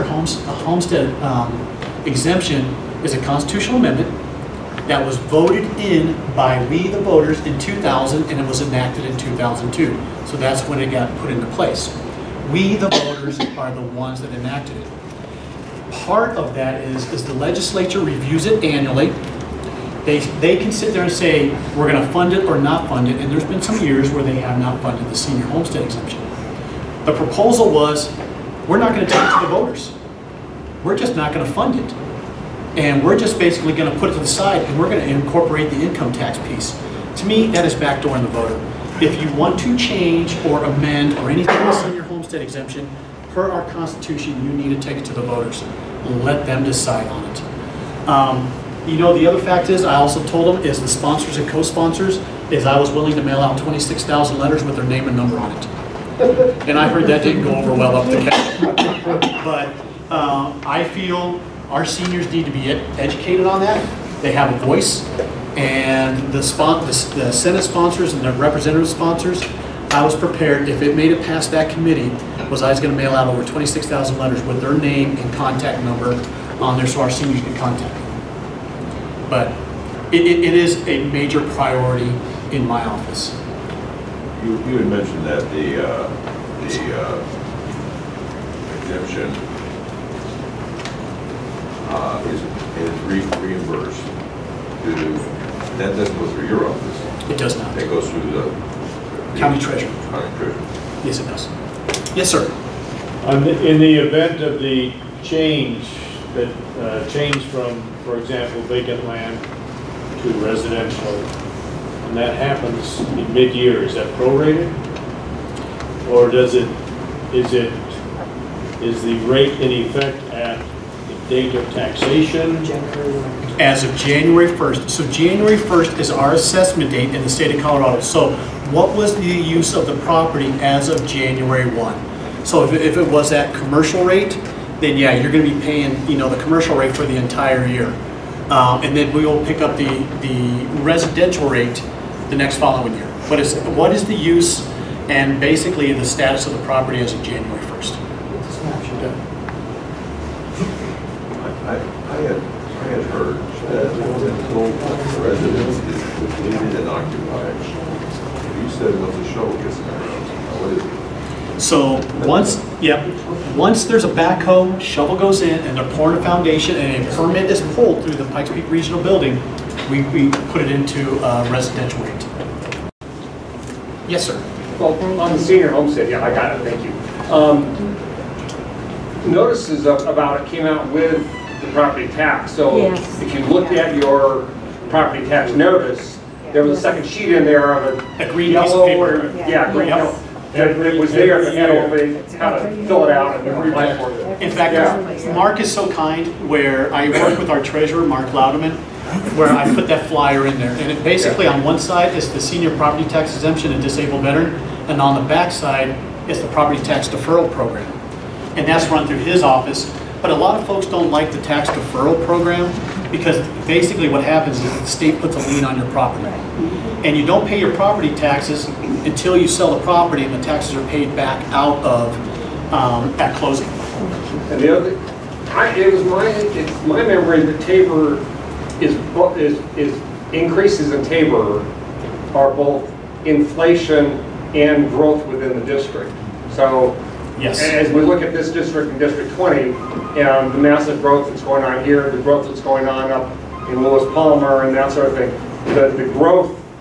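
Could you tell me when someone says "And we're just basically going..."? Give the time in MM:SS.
00:32.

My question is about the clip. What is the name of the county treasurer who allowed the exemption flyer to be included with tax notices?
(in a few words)
Mark Lowderman.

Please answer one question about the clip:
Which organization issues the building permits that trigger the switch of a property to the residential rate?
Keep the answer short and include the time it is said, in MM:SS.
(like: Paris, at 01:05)
Pikes Peak Regional Building, at 02:48.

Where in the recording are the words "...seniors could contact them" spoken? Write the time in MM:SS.
01:17.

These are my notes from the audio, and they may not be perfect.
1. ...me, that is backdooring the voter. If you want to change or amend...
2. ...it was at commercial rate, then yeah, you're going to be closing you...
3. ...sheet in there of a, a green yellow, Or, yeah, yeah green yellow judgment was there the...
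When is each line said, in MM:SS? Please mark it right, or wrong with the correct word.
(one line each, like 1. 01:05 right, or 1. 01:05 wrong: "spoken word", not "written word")
1. 00:37 right
2. 02:12 wrong: "paying", not "closing"
3. 03:07 right.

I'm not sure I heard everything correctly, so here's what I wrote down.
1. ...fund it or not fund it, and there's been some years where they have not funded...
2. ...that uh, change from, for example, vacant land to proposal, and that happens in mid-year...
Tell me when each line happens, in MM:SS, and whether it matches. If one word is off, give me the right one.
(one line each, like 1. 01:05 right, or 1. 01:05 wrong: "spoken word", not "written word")
1. 00:22 right
2. 01:46 wrong: "residential", not "proposal".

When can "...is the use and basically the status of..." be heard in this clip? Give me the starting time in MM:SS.
02:23.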